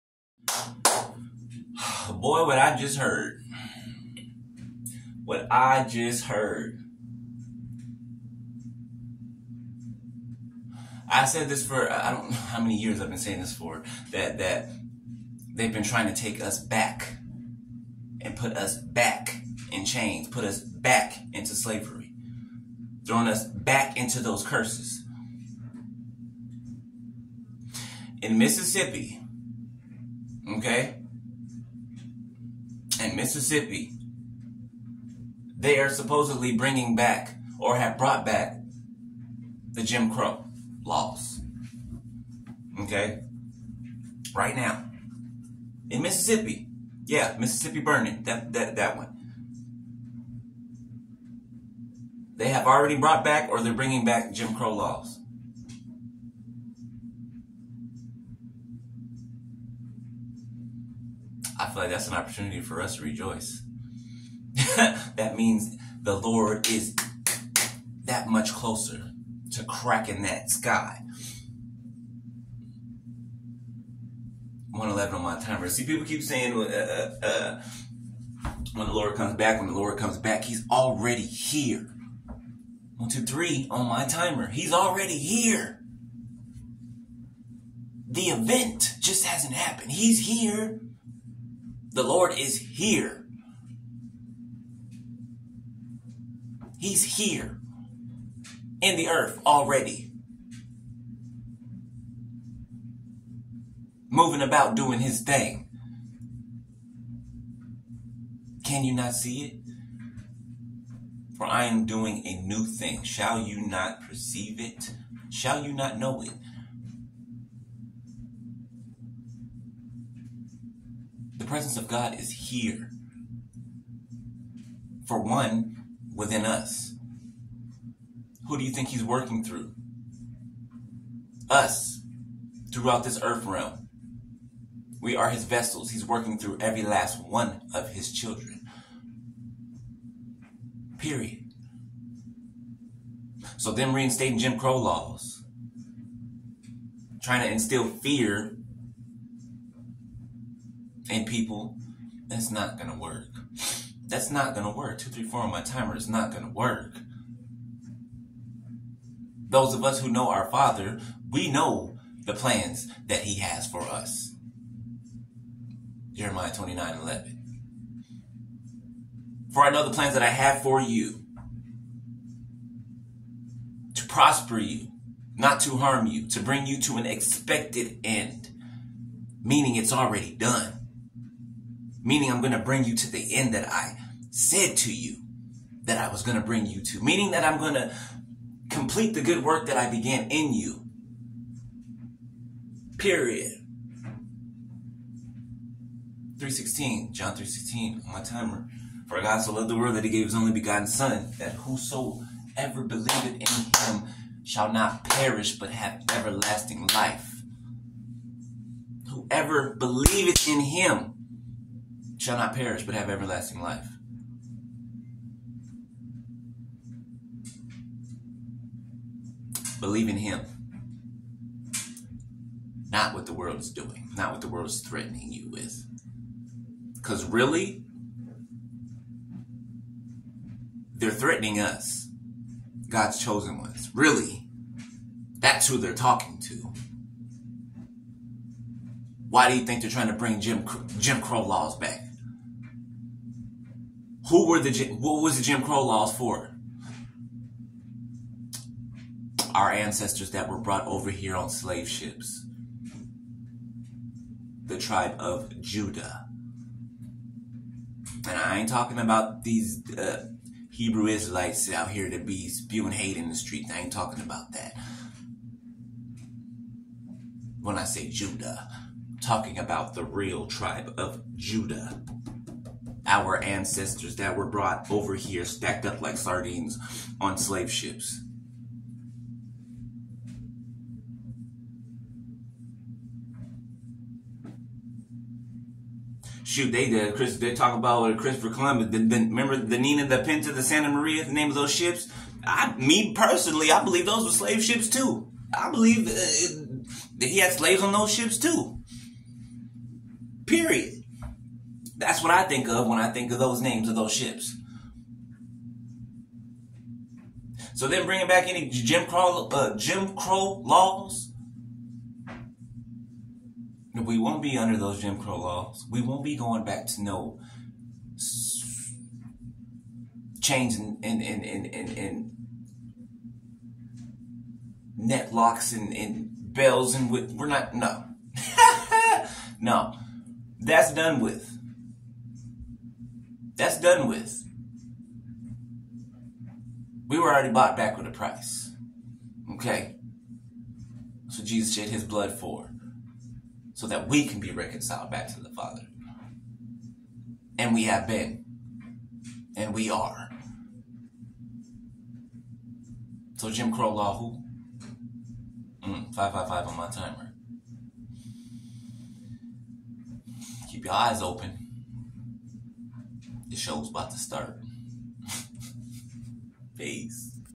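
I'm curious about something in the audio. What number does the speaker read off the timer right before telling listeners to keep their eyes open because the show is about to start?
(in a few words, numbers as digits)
555.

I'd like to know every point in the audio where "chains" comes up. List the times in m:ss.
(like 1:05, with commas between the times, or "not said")
0:19, 5:20.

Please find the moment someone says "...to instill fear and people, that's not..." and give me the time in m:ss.
2:27.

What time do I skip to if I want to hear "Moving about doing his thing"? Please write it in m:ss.
1:44.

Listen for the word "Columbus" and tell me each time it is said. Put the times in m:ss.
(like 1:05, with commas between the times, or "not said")
4:48.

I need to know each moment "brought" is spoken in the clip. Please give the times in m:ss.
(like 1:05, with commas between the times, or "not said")
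0:37, 0:52, 4:10, 4:34.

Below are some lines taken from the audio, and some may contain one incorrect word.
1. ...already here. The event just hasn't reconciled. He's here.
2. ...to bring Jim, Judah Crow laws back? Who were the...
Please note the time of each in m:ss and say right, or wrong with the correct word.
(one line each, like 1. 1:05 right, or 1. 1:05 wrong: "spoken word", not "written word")
1. 1:24 wrong: "happened", not "reconciled"
2. 4:00 wrong: "Jim", not "Judah".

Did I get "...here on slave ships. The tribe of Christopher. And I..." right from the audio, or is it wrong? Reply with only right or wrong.
wrong.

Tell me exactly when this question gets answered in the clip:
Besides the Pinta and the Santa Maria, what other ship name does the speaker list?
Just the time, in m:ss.
4:49.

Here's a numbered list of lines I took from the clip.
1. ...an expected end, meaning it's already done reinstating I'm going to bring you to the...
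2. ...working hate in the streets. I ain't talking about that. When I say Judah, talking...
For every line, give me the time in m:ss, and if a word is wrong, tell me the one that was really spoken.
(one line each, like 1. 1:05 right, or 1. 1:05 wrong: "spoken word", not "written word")
1. 2:56 wrong: "meaning", not "reinstating"
2. 4:22 wrong: "spewing", not "working".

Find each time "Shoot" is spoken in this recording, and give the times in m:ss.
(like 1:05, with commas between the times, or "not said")
4:46.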